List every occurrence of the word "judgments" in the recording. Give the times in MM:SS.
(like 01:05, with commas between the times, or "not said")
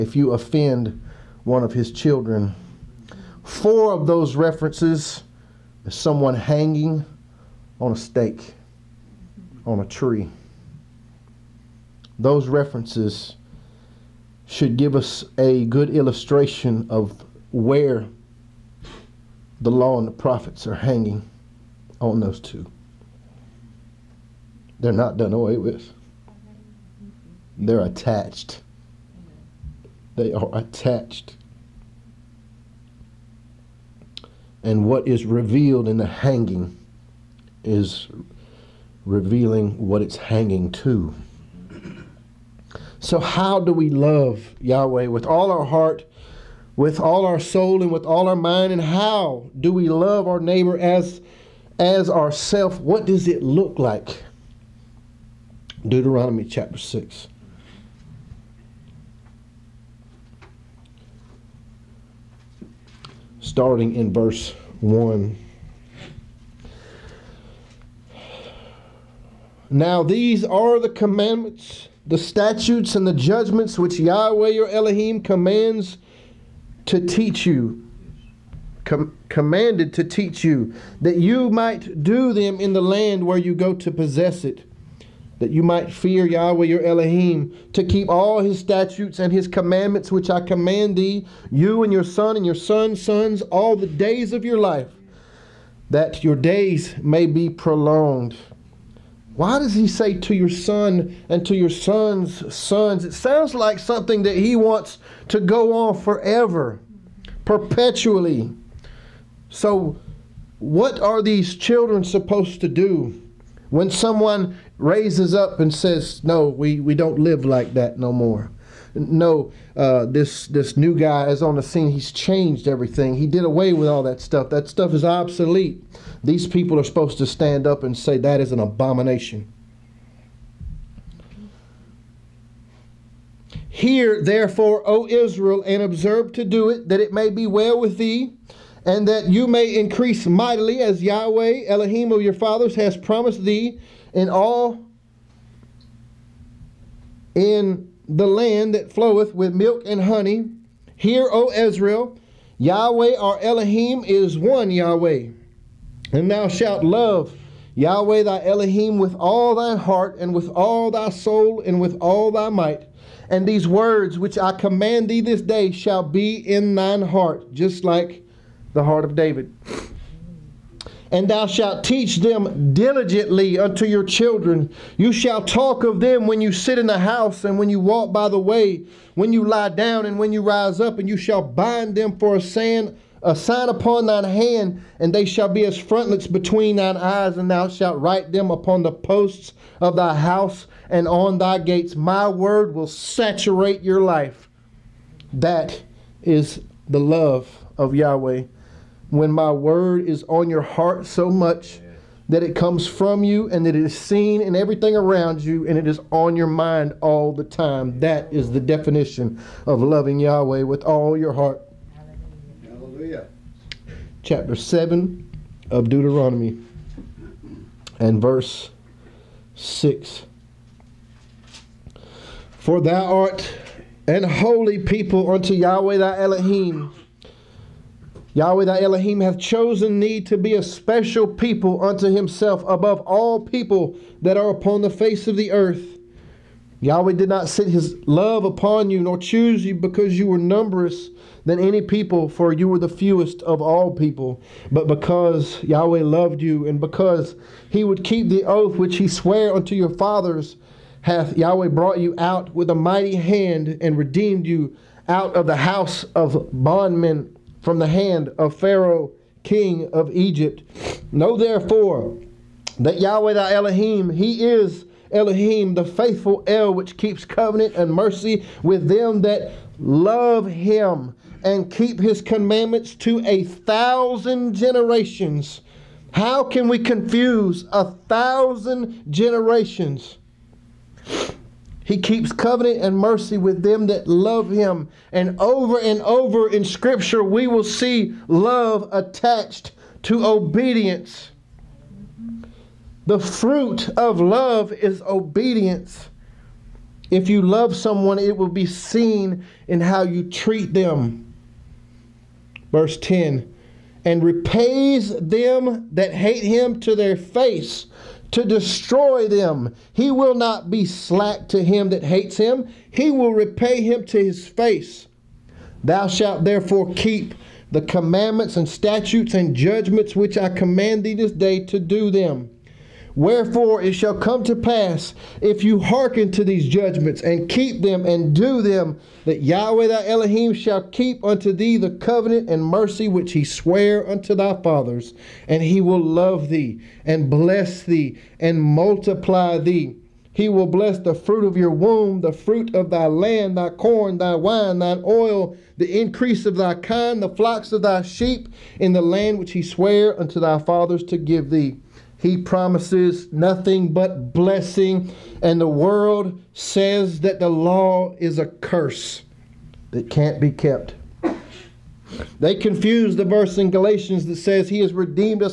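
01:13, 05:19, 05:26.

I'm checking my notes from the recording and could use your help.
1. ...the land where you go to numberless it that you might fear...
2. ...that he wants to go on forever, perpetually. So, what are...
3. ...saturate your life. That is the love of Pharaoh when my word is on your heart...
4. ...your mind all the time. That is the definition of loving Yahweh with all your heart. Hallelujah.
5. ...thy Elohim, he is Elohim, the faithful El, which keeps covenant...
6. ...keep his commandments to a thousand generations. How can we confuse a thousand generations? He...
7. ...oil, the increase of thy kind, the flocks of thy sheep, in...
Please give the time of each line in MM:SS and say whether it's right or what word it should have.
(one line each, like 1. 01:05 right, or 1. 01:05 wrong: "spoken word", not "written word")
1. 01:22 wrong: "possess", not "numberless"
2. 01:44 right
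3. 03:12 wrong: "Yahweh", not "Pharaoh"
4. 03:26 right
5. 04:23 right
6. 04:31 right
7. 05:45 right.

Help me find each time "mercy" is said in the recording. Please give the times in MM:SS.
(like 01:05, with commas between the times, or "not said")
04:27, 04:42, 05:32.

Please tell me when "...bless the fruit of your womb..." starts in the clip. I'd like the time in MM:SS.
05:40.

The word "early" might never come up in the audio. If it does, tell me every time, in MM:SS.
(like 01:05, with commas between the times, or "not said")
not said.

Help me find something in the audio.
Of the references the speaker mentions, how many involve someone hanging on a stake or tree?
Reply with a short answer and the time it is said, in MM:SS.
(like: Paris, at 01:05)
4, at 00:03.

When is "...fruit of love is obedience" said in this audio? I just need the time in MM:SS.
04:53.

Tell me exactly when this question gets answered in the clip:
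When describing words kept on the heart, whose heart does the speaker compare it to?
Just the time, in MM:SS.
02:49.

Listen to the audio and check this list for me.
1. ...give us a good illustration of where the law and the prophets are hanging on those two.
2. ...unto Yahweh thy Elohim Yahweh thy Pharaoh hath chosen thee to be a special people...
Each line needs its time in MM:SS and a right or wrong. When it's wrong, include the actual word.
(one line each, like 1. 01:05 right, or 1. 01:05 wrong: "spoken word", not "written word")
1. 00:14 right
2. 03:45 wrong: "Elohim", not "Pharaoh".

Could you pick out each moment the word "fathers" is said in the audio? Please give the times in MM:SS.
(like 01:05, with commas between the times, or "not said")
02:22, 04:09, 05:34, 05:50.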